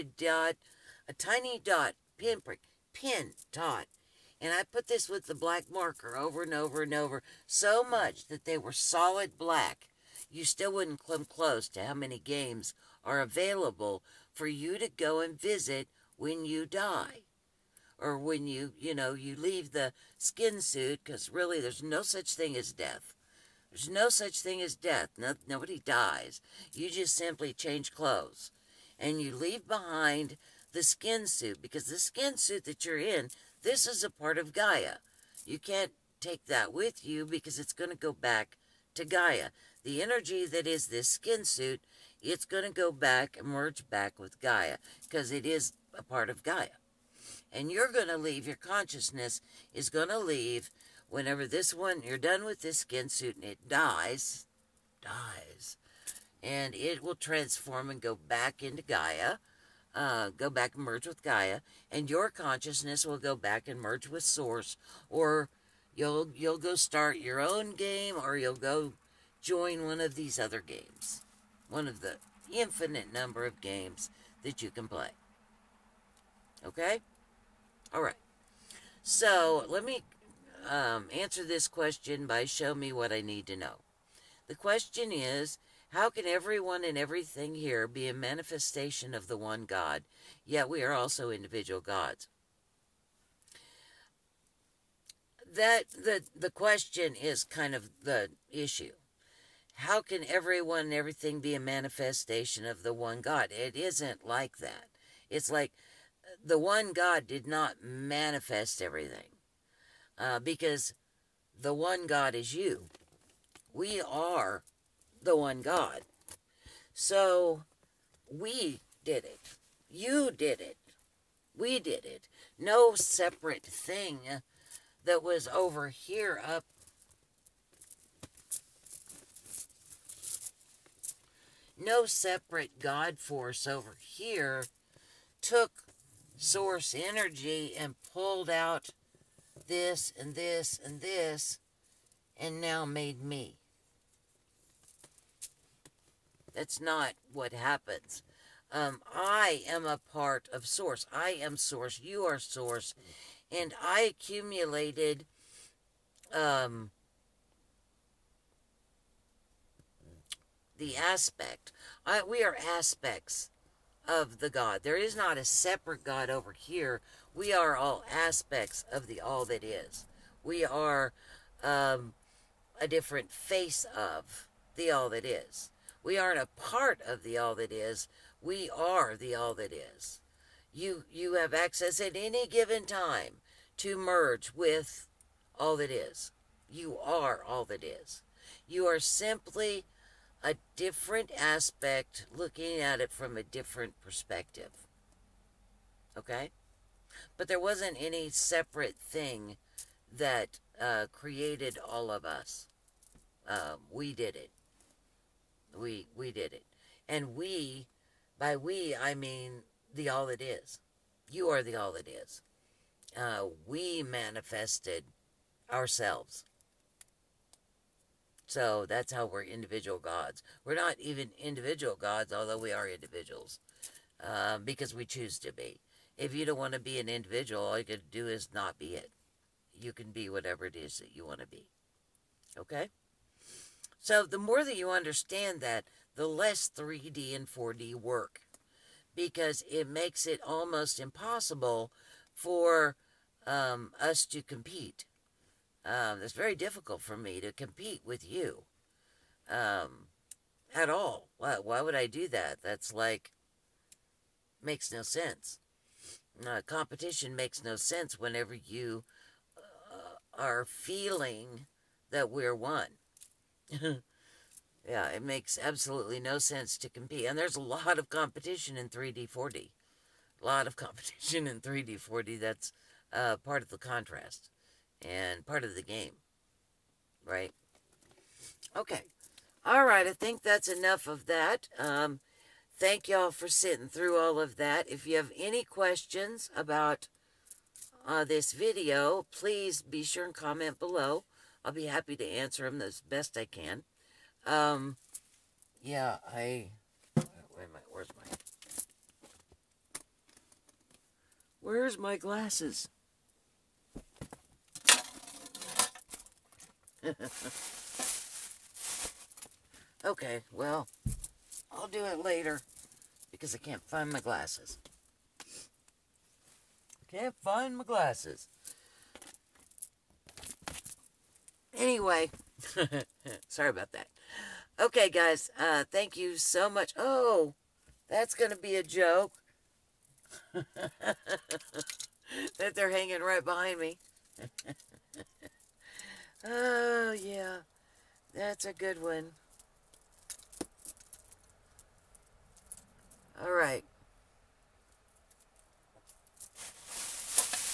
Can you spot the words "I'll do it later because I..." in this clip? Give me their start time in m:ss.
5:11.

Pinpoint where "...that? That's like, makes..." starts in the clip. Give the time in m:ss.
4:12.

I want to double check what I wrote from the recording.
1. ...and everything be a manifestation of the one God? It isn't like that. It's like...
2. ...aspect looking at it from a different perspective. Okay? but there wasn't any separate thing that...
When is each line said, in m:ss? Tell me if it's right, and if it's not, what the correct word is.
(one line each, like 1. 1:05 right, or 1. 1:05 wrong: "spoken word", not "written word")
1. 1:40 right
2. 3:11 right.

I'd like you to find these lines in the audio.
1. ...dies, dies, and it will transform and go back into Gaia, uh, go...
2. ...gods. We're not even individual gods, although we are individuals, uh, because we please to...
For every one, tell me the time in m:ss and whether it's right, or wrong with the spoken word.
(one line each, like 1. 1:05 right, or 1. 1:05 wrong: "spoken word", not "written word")
1. 0:53 right
2. 3:39 wrong: "choose", not "please".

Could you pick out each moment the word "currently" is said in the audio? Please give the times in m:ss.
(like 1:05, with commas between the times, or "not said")
not said.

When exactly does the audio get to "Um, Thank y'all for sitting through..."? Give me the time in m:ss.
4:41.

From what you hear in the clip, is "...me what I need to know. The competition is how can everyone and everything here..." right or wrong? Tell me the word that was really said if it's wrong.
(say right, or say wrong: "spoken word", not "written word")
wrong: "question", not "competition".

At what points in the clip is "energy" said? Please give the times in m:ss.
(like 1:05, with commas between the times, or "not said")
0:40, 2:16.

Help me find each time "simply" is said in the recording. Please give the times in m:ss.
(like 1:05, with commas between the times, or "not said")
0:27, 3:08.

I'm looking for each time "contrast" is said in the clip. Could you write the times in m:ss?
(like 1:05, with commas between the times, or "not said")
4:33.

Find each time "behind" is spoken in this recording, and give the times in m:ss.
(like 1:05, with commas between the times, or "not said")
0:29, 5:33.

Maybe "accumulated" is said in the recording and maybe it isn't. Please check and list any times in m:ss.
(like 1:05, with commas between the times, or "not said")
2:34.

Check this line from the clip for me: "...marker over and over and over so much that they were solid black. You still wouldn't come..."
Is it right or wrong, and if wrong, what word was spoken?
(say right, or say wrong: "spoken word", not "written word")
right.